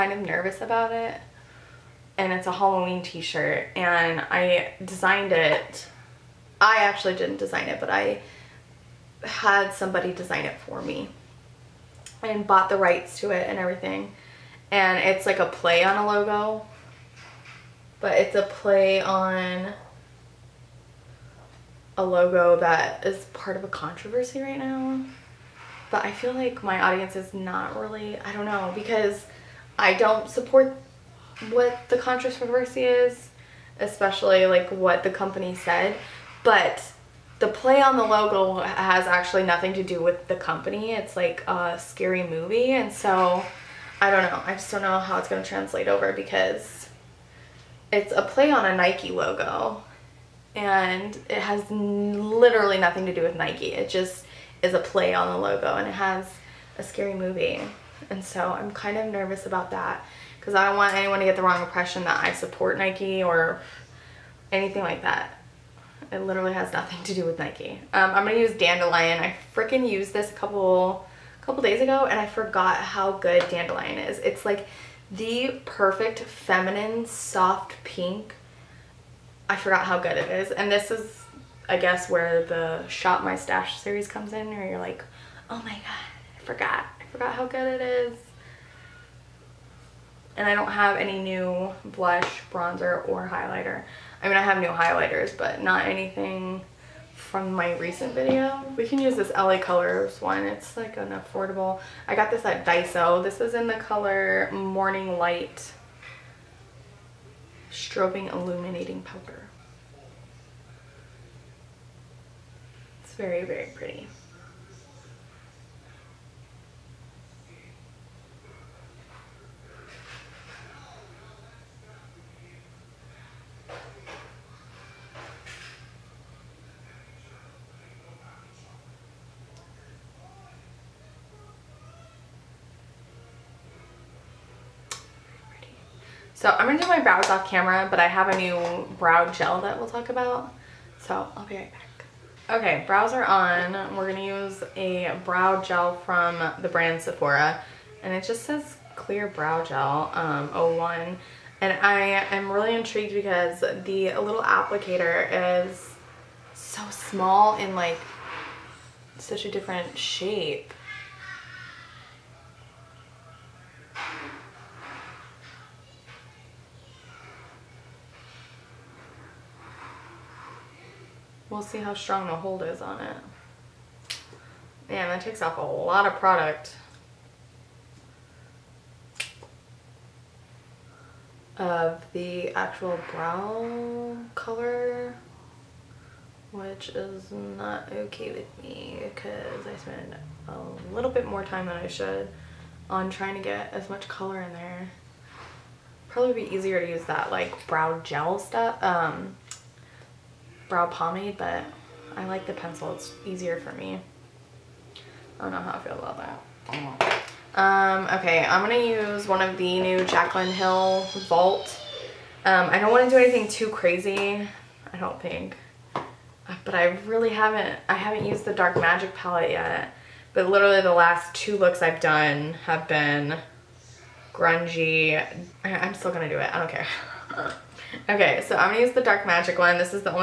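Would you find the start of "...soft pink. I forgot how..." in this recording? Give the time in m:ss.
1:17.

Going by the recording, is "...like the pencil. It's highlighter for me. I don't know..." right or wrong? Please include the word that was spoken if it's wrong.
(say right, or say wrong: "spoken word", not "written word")
wrong: "easier", not "highlighter".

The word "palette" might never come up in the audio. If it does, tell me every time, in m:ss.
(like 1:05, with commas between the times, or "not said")
3:39.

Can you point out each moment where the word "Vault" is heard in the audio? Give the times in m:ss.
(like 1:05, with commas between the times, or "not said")
3:31.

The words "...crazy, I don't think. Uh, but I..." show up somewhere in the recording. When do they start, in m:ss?
3:33.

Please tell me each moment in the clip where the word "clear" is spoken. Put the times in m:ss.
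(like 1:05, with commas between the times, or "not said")
2:28.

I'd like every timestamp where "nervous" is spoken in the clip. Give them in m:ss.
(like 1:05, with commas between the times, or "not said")
0:00, 0:59.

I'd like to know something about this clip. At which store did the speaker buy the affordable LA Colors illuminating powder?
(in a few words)
Daiso.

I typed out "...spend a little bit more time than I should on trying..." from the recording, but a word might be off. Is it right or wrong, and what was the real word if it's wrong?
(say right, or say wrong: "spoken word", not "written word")
right.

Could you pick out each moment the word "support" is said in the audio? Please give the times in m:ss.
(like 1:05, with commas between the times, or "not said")
0:30, 1:02.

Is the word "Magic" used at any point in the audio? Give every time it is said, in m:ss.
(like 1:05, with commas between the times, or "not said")
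3:38, 3:49.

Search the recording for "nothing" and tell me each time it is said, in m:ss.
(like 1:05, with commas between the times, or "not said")
0:39, 0:52, 1:06.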